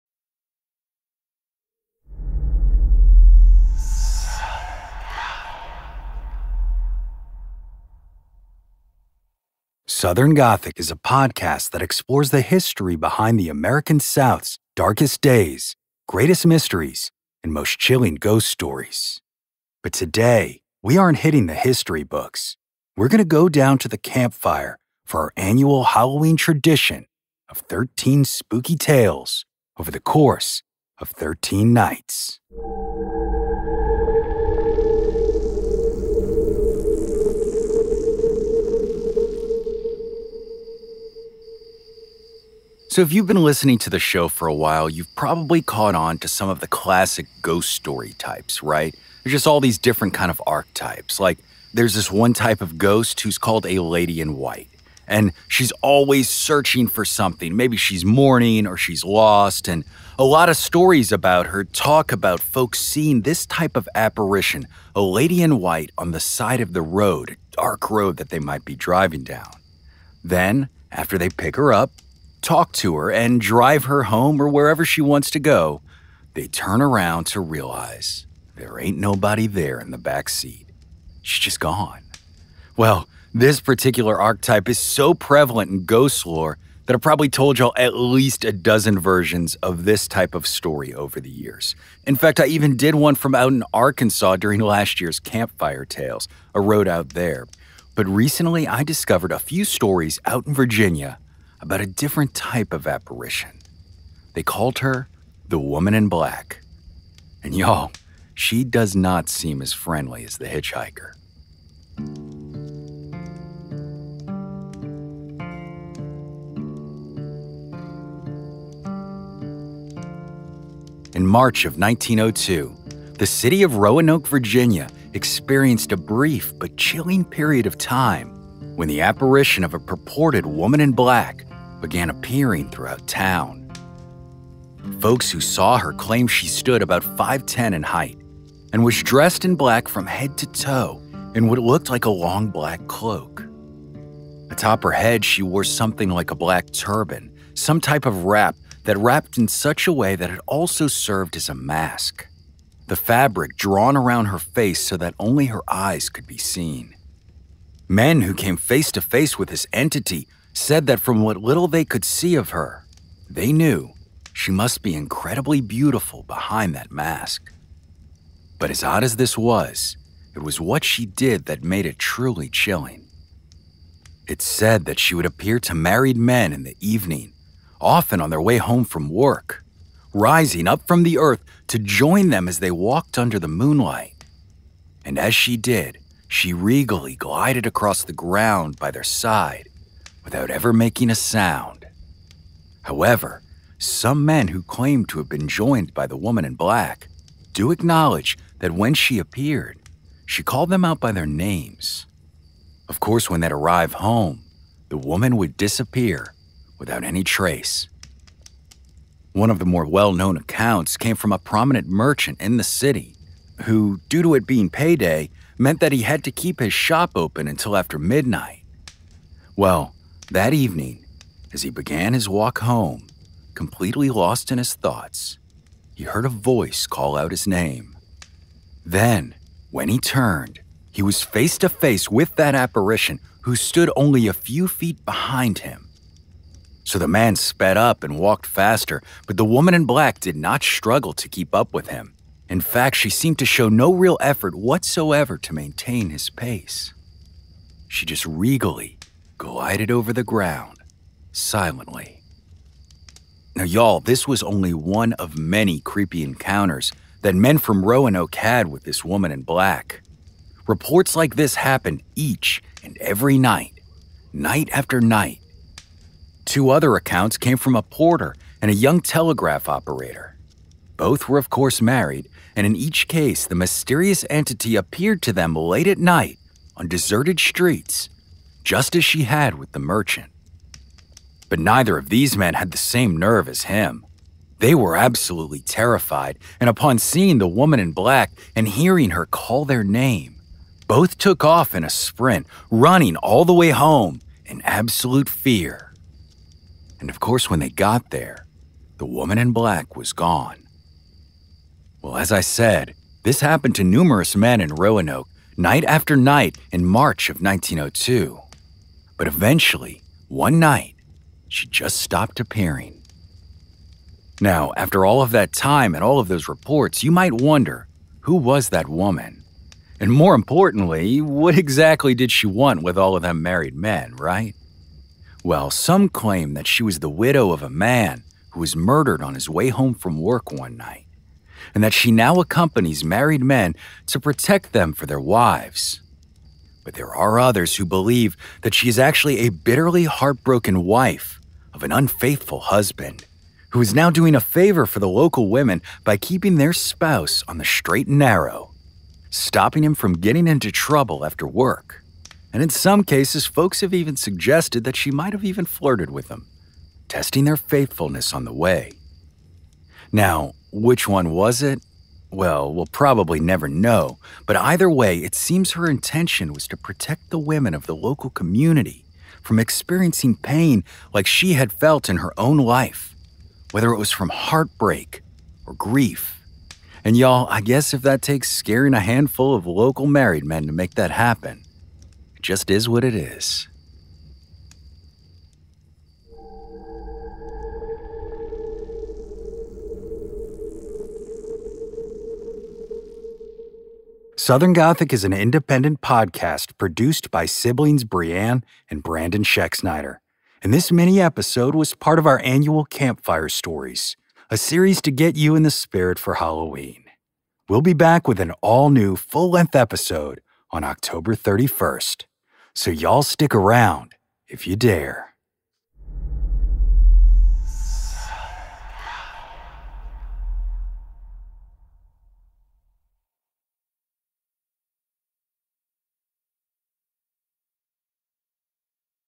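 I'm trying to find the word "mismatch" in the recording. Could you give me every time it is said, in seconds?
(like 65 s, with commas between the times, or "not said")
not said.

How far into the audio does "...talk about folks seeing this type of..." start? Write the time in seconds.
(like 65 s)
61 s.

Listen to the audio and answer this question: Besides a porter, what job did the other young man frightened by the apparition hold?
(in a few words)
Telegraph operator.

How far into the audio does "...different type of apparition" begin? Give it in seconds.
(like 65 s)
101 s.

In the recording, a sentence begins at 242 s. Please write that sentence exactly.
In fact, she seemed to show no real effort whatsoever to maintain his pace.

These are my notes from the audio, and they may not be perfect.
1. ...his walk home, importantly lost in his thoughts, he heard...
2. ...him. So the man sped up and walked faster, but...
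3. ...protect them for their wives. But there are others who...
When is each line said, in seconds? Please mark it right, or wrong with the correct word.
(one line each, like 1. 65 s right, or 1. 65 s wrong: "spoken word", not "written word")
1. 222 s wrong: "completely", not "importantly"
2. 235 s right
3. 334 s right.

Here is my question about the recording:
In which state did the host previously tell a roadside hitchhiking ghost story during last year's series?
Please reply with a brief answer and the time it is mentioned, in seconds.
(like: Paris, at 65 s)
Arkansas, at 93 s.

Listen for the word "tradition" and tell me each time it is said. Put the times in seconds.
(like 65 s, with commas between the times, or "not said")
26 s.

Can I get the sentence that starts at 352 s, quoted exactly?
And in some cases, folks have even suggested that she might have even flirted with him, testing their faithfulness on the way.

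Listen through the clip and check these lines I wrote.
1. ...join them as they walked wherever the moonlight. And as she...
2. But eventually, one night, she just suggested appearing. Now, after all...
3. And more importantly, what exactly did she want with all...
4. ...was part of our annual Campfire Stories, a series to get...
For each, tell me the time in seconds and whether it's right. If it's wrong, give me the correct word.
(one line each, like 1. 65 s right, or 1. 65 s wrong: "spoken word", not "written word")
1. 181 s wrong: "under", not "wherever"
2. 309 s wrong: "stopped", not "suggested"
3. 319 s right
4. 401 s right.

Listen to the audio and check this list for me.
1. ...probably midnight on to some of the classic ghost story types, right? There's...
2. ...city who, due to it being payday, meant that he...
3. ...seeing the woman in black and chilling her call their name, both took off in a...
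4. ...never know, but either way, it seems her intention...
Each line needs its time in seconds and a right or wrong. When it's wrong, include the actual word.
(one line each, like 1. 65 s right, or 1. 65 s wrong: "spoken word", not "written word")
1. 45 s wrong: "caught", not "midnight"
2. 212 s right
3. 286 s wrong: "hearing", not "chilling"
4. 363 s right.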